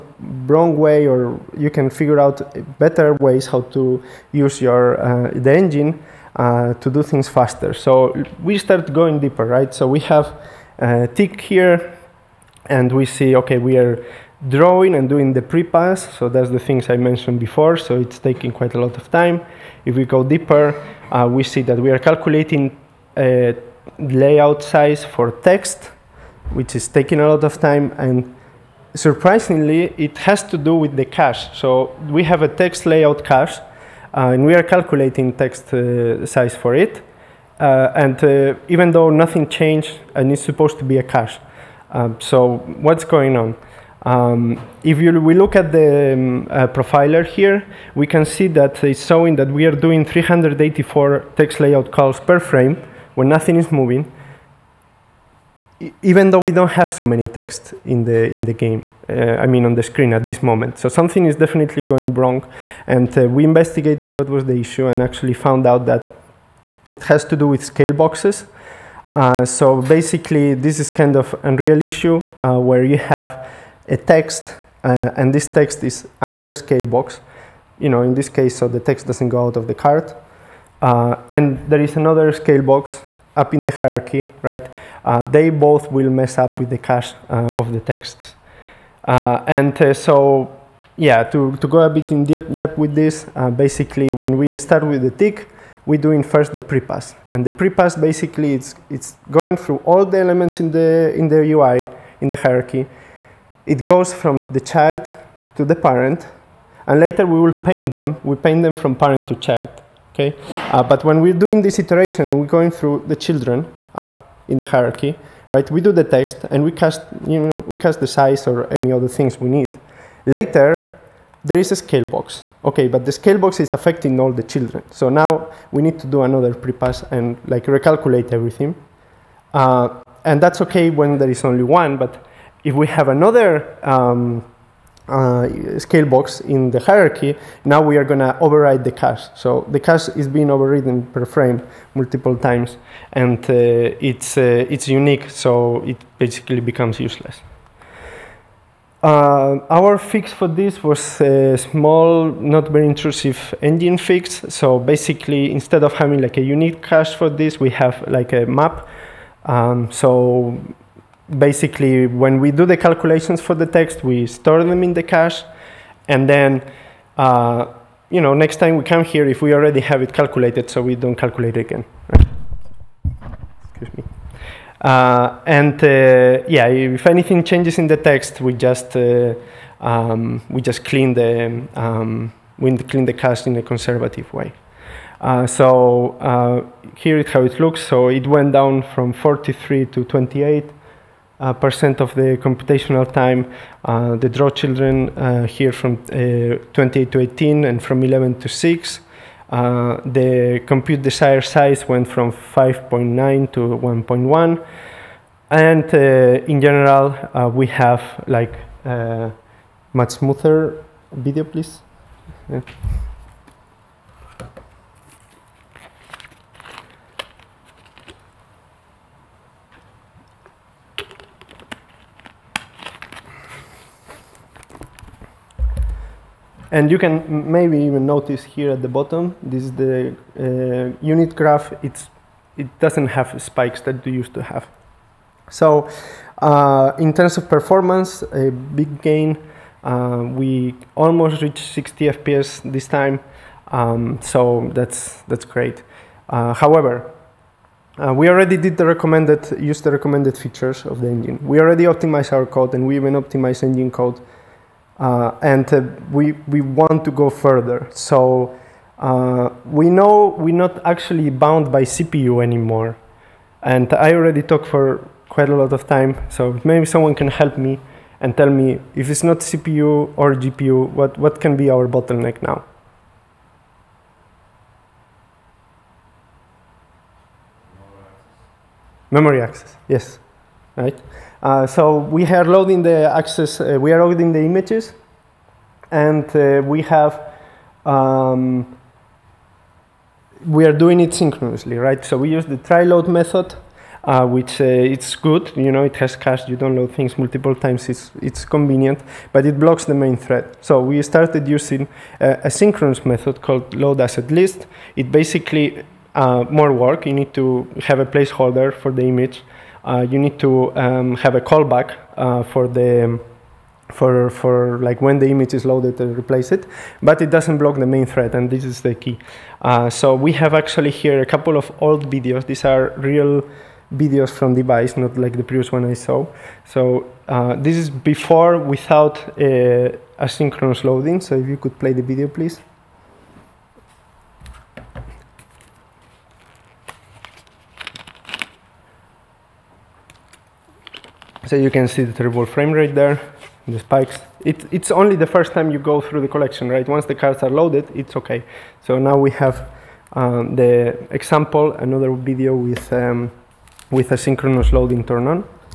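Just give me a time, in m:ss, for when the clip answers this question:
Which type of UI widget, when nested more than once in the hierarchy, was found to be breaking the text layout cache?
1:07.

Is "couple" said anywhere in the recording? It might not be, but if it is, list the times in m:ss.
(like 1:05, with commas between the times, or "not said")
5:21.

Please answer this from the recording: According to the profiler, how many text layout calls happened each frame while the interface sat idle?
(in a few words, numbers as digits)
384.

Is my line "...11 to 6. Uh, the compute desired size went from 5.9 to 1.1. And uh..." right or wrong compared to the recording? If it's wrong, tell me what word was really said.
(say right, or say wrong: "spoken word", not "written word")
right.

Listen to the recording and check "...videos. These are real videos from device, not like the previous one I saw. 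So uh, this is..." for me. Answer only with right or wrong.
right.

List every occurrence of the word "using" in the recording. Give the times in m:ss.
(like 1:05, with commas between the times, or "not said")
5:01.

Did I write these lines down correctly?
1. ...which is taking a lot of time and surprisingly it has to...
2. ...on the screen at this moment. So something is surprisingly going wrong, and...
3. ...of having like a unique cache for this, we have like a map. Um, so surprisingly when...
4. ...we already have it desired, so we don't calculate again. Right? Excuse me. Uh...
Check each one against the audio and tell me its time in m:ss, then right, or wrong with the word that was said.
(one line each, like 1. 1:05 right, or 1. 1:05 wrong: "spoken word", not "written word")
1. 0:26 right
2. 0:59 wrong: "definitely", not "surprisingly"
3. 2:35 wrong: "basically", not "surprisingly"
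4. 2:49 wrong: "calculated", not "desired".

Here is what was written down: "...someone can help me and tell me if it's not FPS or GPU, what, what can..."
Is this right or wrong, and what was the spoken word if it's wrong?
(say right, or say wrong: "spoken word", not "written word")
wrong: "CPU", not "FPS".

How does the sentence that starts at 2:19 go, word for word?
So the cache is being overridden per frame multiple times, and uh, it's, uh, it's unique, so it basically becomes useless.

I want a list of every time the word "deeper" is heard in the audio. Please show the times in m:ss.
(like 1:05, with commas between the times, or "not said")
0:09, 0:20.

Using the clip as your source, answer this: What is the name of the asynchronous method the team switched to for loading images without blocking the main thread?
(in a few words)
load asset list.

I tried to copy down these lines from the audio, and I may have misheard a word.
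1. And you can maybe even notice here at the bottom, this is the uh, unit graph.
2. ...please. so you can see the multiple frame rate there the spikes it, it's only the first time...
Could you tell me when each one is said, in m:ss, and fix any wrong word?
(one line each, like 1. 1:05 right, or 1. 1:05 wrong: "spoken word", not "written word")
1. 3:46 right
2. 5:32 wrong: "terrible", not "multiple".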